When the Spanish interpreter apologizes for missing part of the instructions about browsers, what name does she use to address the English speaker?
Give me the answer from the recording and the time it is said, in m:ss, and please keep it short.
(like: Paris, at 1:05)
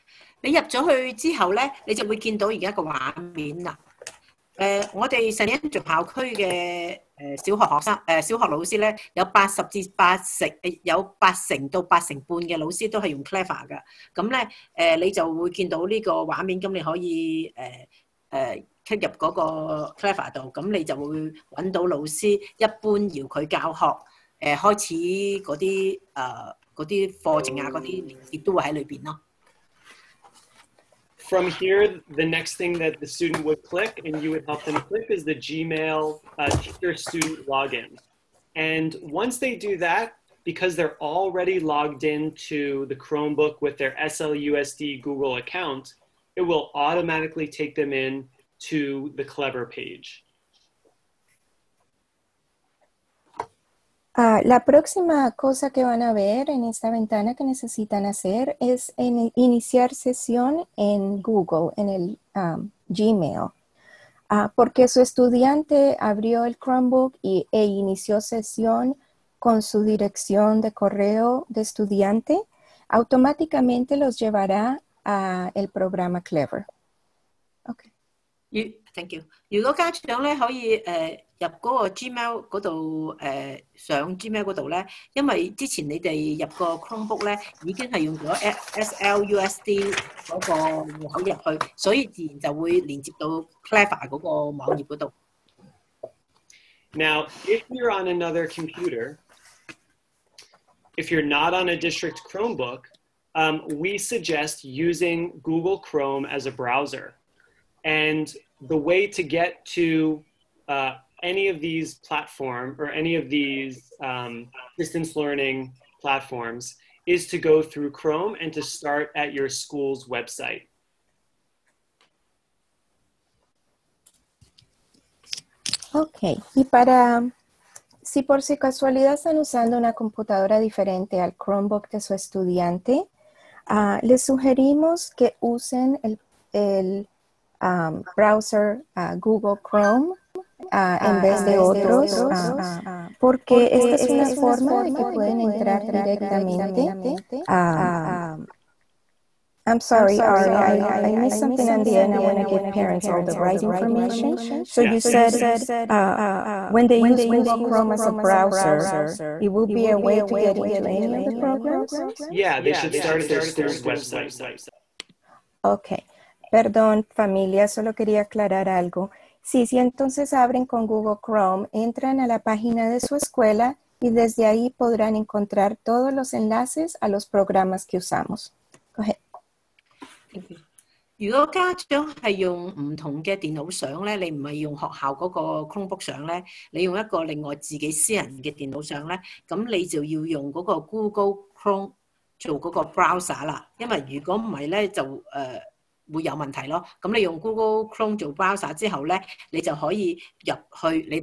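Ari, at 2:30.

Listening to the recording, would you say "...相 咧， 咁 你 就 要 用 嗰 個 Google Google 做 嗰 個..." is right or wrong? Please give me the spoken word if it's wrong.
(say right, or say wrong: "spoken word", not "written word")
wrong: "Chrome", not "Google".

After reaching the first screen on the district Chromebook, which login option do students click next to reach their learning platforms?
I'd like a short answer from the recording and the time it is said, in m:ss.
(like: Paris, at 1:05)
teacher student login, at 0:36.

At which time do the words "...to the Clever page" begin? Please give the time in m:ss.
0:48.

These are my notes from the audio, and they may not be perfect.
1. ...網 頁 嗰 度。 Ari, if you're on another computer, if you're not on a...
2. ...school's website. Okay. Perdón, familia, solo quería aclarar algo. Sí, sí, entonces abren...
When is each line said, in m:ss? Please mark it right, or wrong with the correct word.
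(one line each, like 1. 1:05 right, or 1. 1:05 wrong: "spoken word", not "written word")
1. 1:34 wrong: "Now", not "Ari"
2. 2:43 right.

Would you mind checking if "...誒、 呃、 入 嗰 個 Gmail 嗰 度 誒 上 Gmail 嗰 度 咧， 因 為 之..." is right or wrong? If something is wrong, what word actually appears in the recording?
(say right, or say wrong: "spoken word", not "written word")
right.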